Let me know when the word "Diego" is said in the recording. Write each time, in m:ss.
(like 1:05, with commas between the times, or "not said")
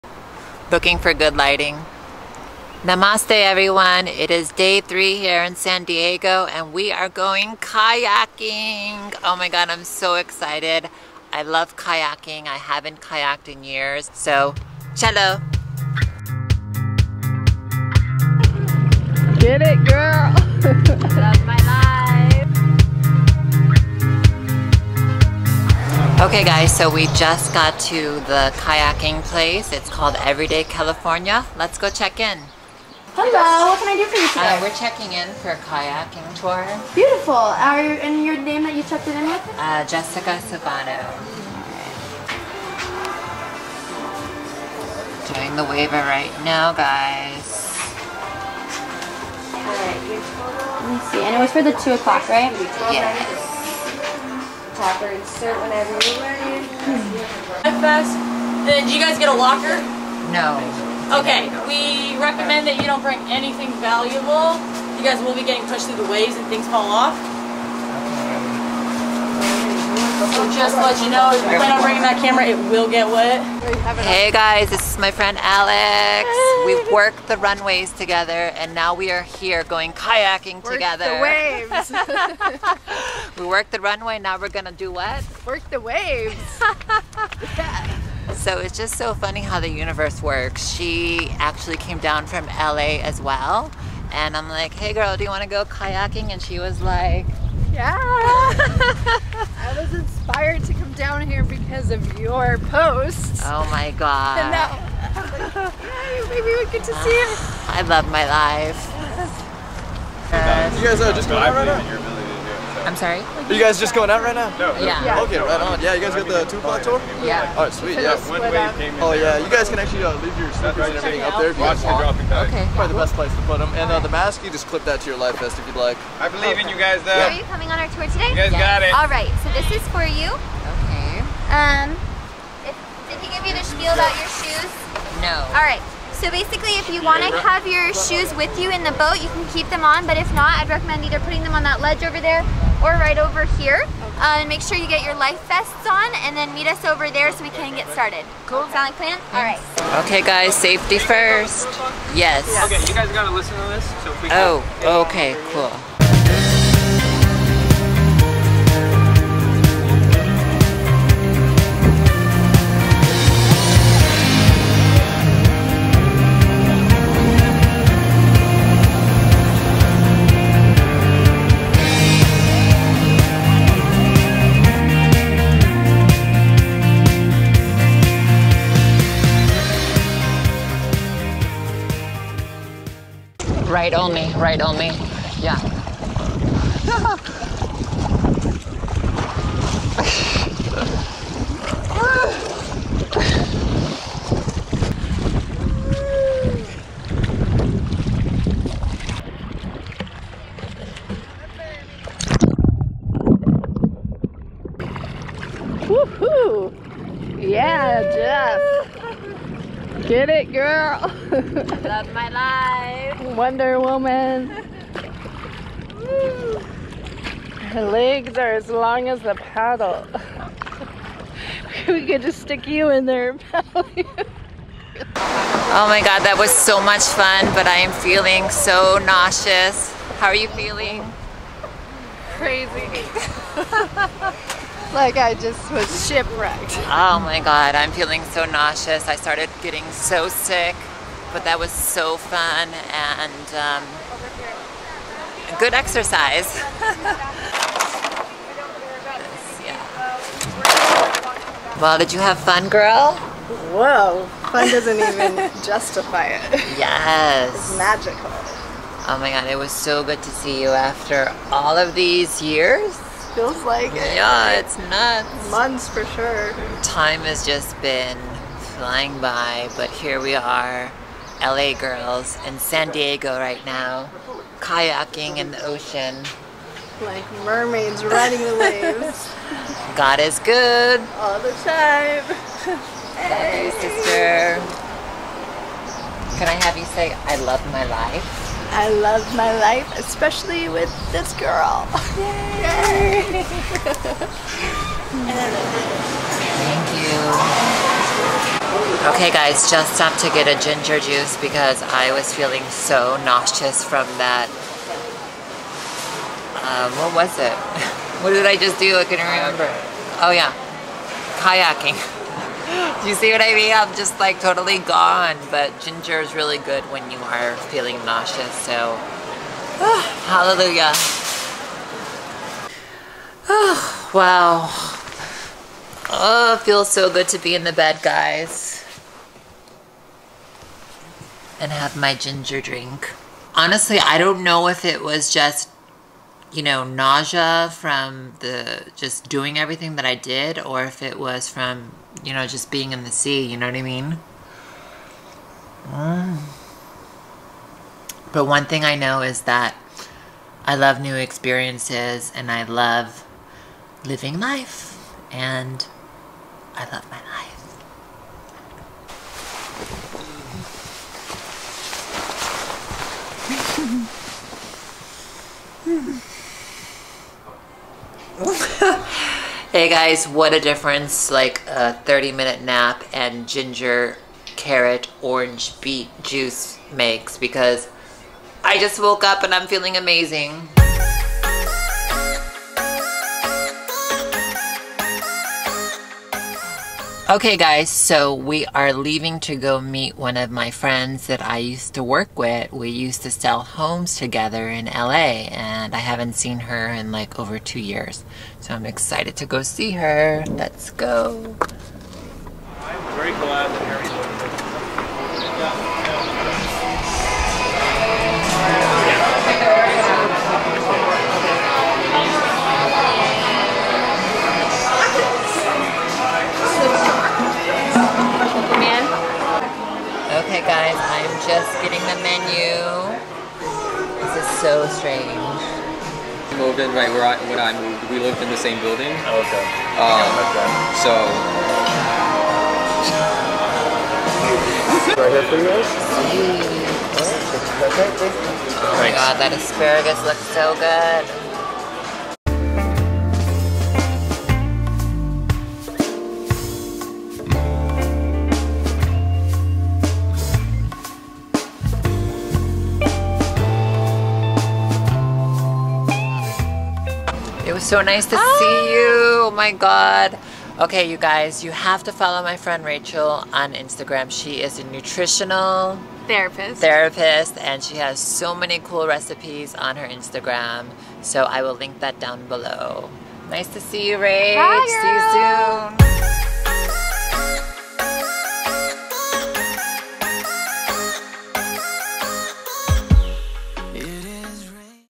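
0:05, 4:32.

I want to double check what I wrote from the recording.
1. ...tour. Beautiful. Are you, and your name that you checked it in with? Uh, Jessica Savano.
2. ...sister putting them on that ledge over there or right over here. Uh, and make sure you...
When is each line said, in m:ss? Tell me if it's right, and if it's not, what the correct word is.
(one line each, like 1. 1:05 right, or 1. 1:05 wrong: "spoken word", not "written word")
1. 0:36 right
2. 2:21 wrong: "either", not "sister".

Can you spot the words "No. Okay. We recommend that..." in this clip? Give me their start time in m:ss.
1:00.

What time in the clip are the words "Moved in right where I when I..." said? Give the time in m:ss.
7:06.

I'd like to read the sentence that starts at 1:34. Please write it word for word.
And I'm like, hey girl, do you wanna go kayaking?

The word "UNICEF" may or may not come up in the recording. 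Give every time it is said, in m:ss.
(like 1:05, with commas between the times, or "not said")
not said.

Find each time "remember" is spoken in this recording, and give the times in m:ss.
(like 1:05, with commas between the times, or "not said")
5:09.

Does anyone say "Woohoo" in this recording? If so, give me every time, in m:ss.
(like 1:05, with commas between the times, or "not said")
3:25.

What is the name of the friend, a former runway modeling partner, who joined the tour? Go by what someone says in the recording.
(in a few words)
Alex.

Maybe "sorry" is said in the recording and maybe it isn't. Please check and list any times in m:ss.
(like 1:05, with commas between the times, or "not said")
1:52.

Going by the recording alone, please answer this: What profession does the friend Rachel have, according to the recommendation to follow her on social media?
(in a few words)
Nutritional therapist.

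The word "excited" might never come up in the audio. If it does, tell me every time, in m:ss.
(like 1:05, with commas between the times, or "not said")
0:10, 6:38.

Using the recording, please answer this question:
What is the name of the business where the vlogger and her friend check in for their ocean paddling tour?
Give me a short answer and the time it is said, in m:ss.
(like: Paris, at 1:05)
Everyday California, at 0:30.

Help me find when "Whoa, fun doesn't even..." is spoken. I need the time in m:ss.
4:13.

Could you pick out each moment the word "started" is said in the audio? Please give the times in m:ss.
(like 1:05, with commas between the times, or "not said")
2:27, 3:59.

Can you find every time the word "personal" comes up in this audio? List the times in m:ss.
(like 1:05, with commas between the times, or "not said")
not said.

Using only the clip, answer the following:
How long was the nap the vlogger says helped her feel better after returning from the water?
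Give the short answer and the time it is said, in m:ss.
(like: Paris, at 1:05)
30 minutes, at 6:12.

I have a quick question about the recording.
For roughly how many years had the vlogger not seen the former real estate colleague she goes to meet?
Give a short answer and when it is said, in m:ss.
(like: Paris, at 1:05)
2 years, at 6:37.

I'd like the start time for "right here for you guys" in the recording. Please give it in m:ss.
7:15.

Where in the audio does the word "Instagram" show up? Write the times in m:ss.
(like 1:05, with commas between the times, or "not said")
7:43, 7:50.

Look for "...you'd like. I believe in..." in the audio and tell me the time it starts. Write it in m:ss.
2:05.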